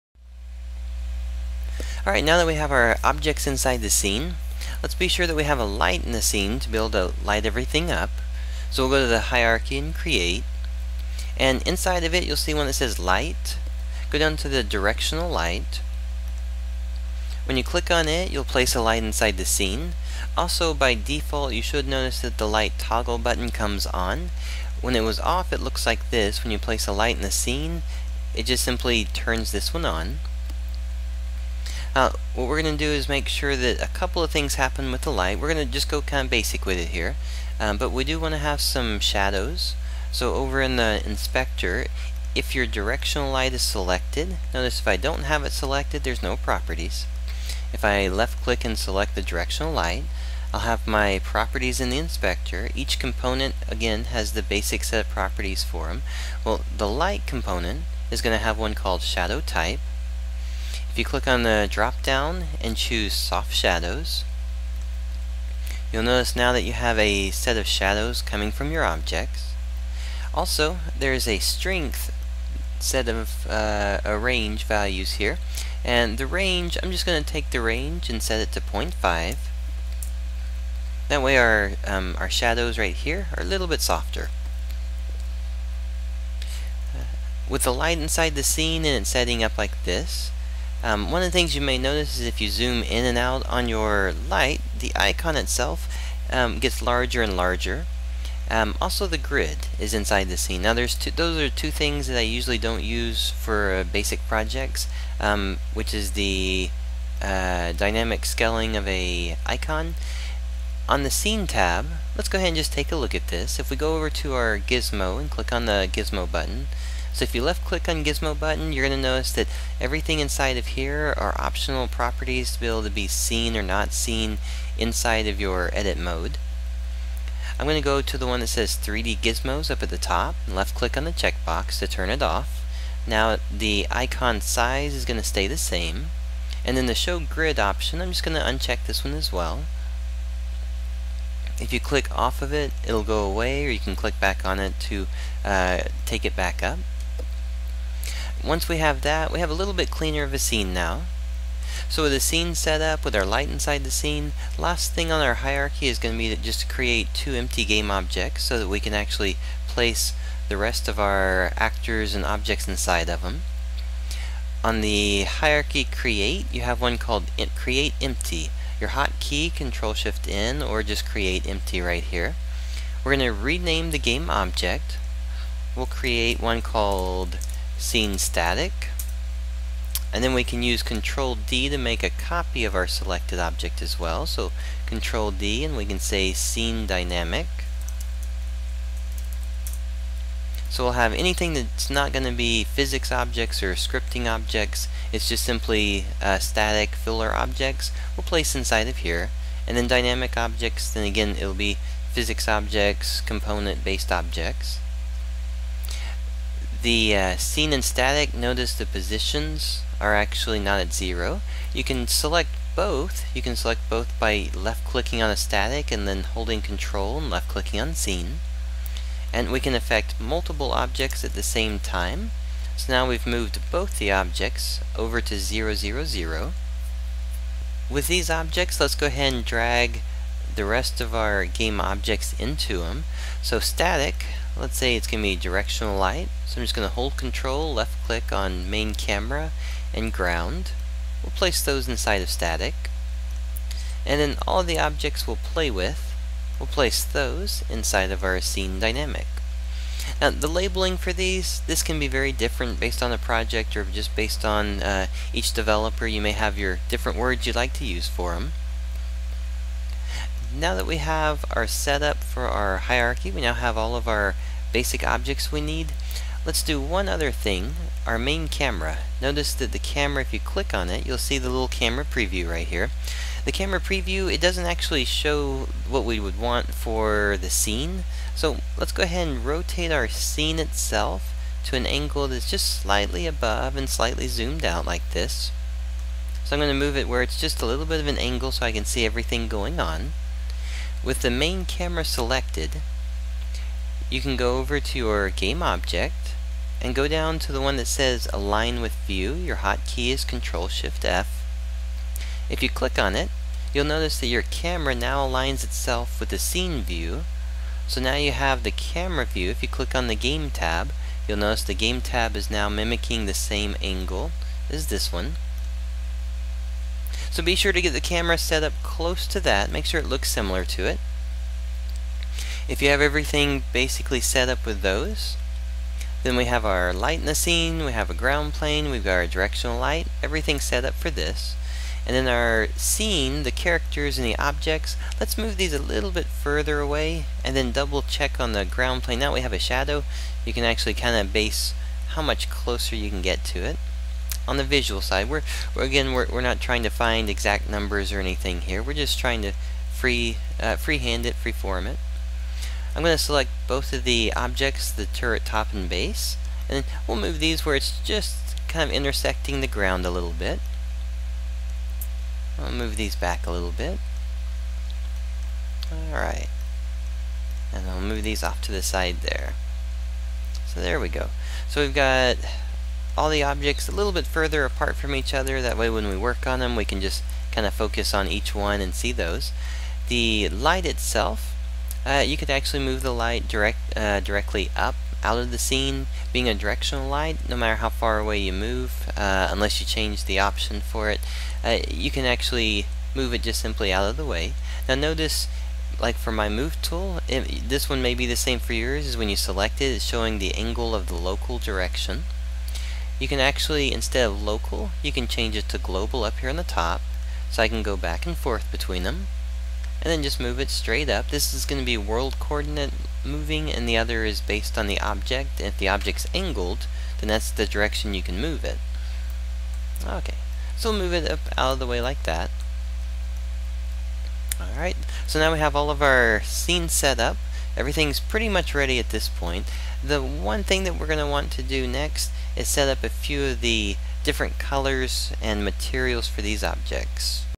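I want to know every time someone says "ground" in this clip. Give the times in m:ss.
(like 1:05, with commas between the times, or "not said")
4:00, 5:28, 5:38, 5:59.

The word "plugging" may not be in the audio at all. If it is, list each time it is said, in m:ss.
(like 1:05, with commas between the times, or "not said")
not said.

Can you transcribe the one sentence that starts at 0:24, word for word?
When it was off, it looks like this.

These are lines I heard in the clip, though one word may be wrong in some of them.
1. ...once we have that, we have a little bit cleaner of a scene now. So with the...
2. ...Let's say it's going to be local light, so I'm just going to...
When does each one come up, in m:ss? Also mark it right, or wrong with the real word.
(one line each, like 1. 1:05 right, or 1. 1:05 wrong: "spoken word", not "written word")
1. 2:28 right
2. 3:54 wrong: "directional", not "local".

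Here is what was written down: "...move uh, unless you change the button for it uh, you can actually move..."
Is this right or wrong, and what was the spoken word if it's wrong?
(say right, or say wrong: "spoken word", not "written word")
wrong: "option", not "button".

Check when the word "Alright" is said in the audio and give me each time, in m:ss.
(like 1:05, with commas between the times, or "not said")
0:02, 6:06, 7:04.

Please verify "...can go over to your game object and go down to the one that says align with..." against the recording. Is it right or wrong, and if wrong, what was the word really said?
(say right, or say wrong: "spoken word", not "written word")
right.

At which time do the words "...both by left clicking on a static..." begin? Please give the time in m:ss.
3:33.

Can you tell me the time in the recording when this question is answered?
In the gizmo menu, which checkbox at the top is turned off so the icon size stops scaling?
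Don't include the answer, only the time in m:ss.
2:08.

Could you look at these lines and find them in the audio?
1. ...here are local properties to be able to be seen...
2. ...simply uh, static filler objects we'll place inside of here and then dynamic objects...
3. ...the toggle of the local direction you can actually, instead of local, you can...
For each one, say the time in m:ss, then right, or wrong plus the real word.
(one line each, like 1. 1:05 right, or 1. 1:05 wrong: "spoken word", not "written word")
1. 2:00 wrong: "optional", not "local"
2. 3:15 right
3. 6:40 wrong: "angle", not "toggle".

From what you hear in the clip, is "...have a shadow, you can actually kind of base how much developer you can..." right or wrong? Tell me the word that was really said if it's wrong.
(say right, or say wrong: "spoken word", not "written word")
wrong: "closer", not "developer".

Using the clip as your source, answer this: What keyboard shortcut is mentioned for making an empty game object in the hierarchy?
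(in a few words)
Control Shift N.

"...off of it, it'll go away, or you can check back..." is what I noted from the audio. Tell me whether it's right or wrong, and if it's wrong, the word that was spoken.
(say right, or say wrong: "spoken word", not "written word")
wrong: "click", not "check".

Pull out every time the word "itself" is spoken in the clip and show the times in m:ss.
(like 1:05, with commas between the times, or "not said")
1:35, 4:40, 5:05, 6:20.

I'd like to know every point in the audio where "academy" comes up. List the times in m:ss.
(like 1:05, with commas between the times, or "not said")
not said.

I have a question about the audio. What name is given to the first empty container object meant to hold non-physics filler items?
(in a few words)
Scene static.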